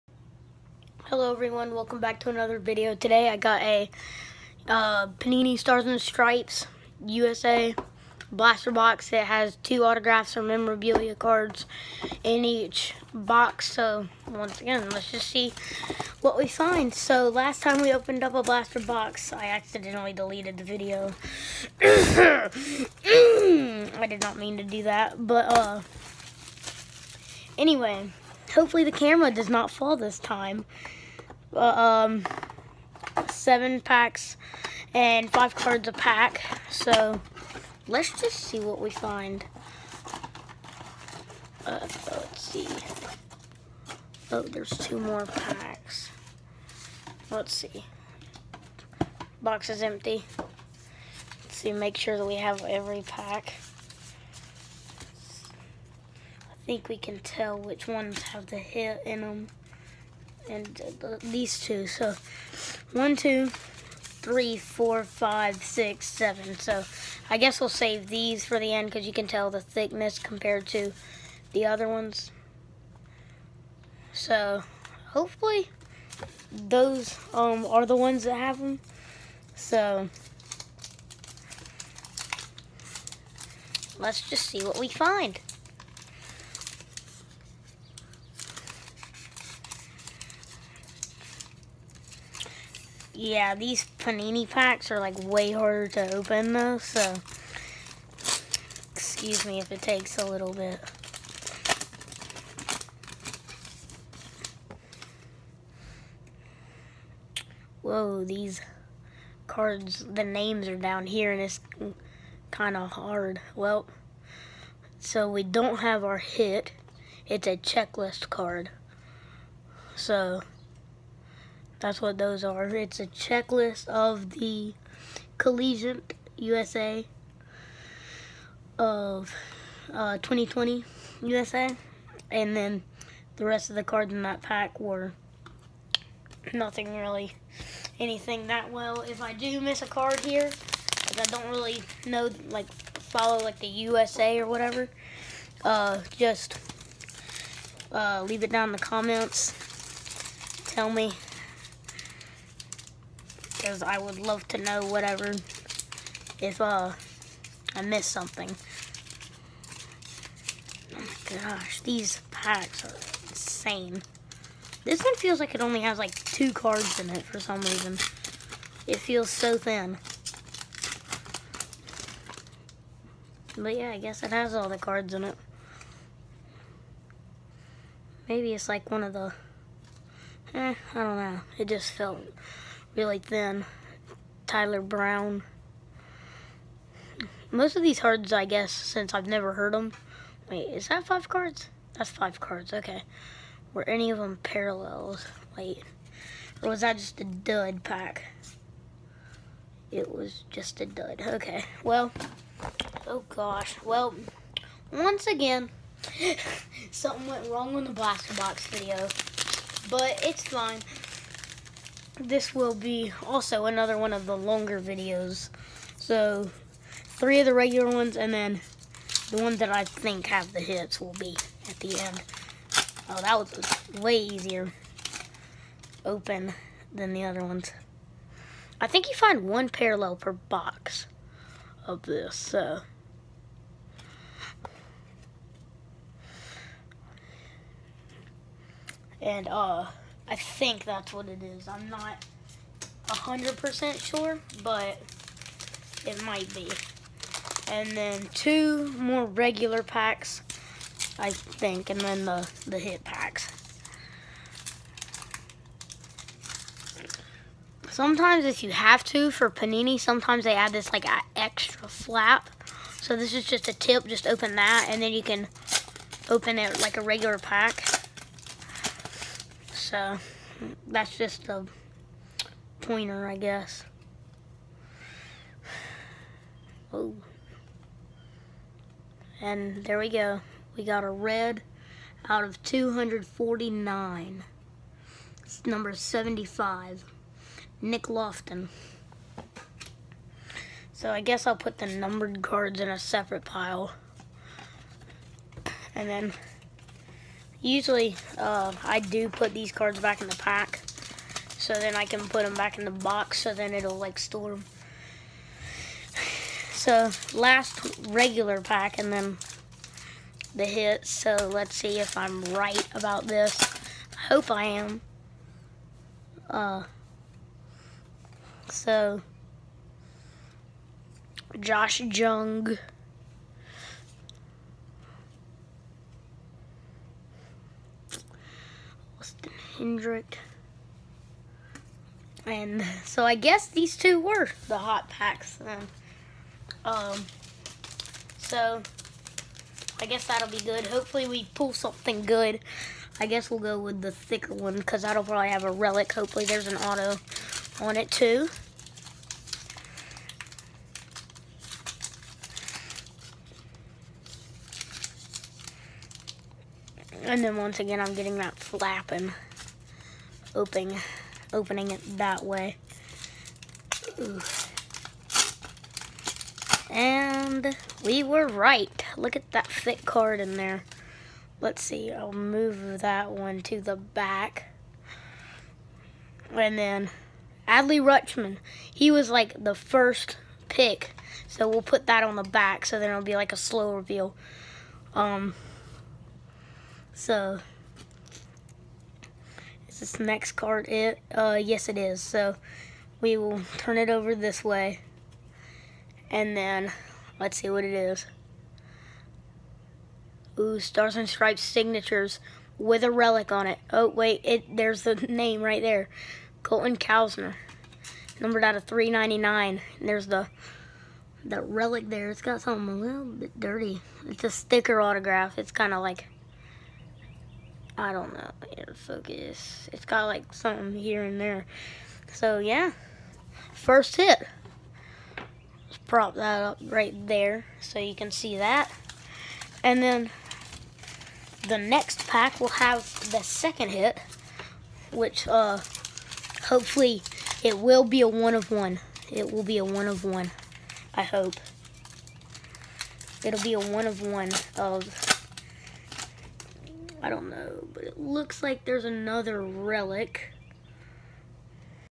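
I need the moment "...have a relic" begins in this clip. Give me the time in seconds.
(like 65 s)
345 s.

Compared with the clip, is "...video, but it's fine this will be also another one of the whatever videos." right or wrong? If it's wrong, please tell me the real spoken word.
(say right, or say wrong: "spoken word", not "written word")
wrong: "longer", not "whatever".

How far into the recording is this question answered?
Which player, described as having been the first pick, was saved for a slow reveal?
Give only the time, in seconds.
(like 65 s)
377 s.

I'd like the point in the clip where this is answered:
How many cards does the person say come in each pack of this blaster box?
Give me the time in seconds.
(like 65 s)
35 s.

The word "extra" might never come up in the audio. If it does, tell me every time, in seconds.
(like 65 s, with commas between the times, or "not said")
261 s.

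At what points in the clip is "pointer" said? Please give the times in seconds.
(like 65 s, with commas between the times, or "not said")
272 s.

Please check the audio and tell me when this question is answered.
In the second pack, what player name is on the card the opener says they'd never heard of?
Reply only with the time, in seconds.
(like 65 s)
184 s.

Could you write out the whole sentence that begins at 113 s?
Well, so we don't have our hit.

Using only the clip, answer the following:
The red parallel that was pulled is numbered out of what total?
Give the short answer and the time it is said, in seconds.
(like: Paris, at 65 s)
249, at 282 s.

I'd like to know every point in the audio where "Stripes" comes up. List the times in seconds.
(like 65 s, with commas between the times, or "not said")
5 s, 401 s.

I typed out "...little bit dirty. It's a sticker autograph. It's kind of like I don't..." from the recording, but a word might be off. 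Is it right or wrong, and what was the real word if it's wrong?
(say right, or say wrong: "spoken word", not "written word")
right.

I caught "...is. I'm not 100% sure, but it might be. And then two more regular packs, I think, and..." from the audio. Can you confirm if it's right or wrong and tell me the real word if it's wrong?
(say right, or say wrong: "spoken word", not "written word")
right.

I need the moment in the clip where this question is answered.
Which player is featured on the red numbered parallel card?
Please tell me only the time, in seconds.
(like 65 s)
287 s.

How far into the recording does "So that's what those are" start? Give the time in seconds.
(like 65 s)
119 s.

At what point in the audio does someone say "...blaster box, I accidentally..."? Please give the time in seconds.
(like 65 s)
18 s.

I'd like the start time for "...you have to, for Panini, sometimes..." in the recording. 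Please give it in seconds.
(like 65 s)
258 s.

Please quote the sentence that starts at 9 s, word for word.
It has two autographs or memorabilia cards in each box.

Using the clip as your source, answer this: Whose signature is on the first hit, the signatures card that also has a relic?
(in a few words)
Colton Cowser.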